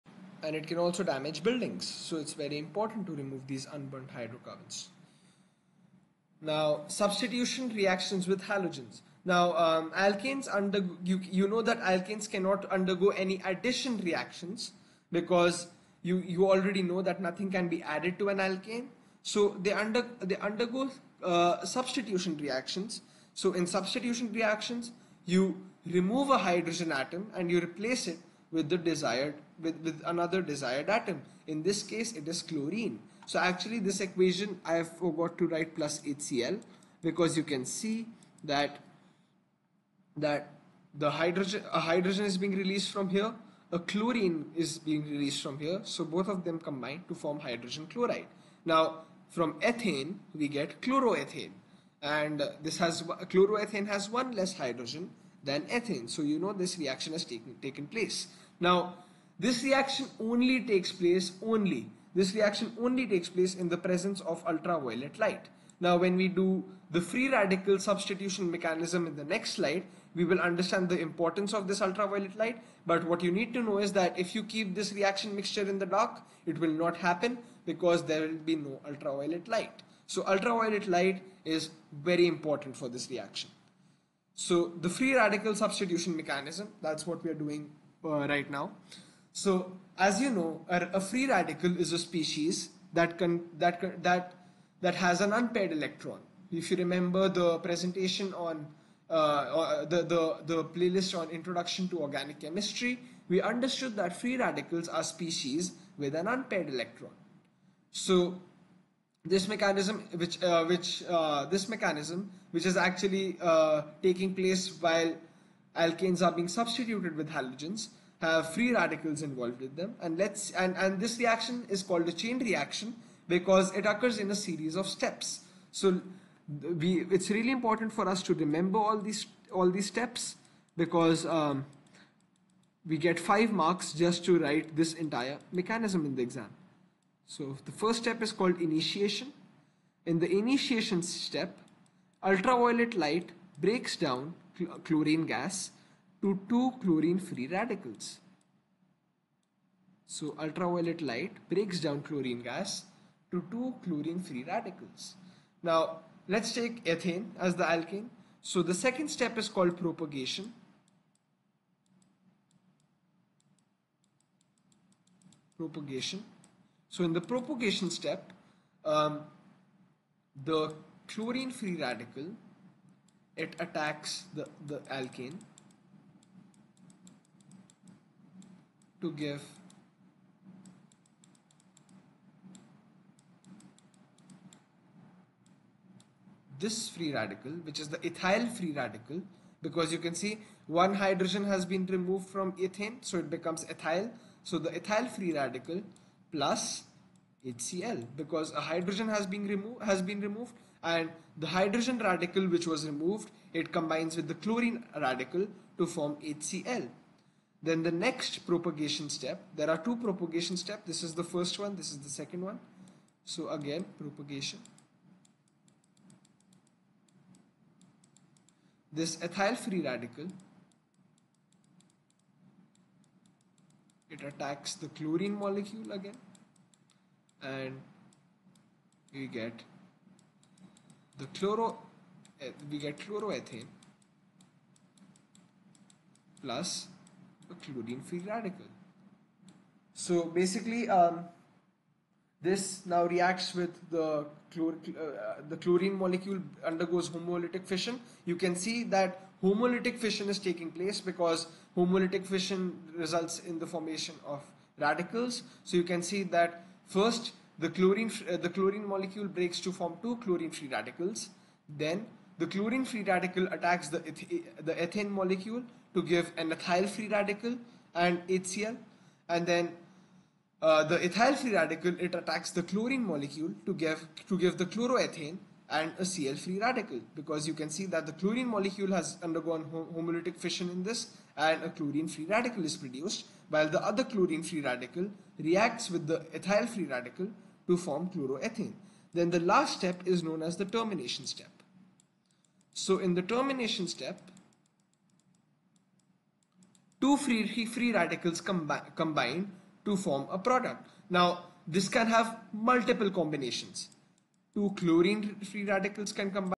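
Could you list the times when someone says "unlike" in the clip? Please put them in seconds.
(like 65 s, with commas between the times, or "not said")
not said.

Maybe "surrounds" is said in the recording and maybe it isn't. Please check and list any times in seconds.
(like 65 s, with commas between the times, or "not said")
not said.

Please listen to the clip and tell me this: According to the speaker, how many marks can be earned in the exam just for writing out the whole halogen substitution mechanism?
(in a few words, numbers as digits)
5.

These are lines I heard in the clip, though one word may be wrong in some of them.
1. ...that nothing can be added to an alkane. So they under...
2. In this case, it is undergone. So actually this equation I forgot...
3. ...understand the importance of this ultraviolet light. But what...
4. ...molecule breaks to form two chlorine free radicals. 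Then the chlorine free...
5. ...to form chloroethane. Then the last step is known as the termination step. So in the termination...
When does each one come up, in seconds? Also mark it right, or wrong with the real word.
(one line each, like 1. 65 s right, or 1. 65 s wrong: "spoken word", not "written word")
1. 17 s right
2. 31 s wrong: "chlorine", not "undergone"
3. 70 s right
4. 258 s right
5. 287 s right.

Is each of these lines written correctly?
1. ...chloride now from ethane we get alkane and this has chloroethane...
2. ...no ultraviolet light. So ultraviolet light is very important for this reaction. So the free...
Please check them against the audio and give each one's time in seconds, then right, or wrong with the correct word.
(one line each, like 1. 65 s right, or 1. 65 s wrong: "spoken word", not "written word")
1. 47 s wrong: "chloroethane", not "alkane"
2. 78 s right.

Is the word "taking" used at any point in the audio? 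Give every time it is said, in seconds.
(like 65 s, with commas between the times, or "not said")
114 s, 250 s.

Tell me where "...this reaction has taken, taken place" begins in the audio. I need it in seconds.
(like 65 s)
56 s.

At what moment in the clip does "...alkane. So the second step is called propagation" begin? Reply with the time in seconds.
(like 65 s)
157 s.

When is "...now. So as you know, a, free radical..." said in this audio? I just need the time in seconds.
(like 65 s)
88 s.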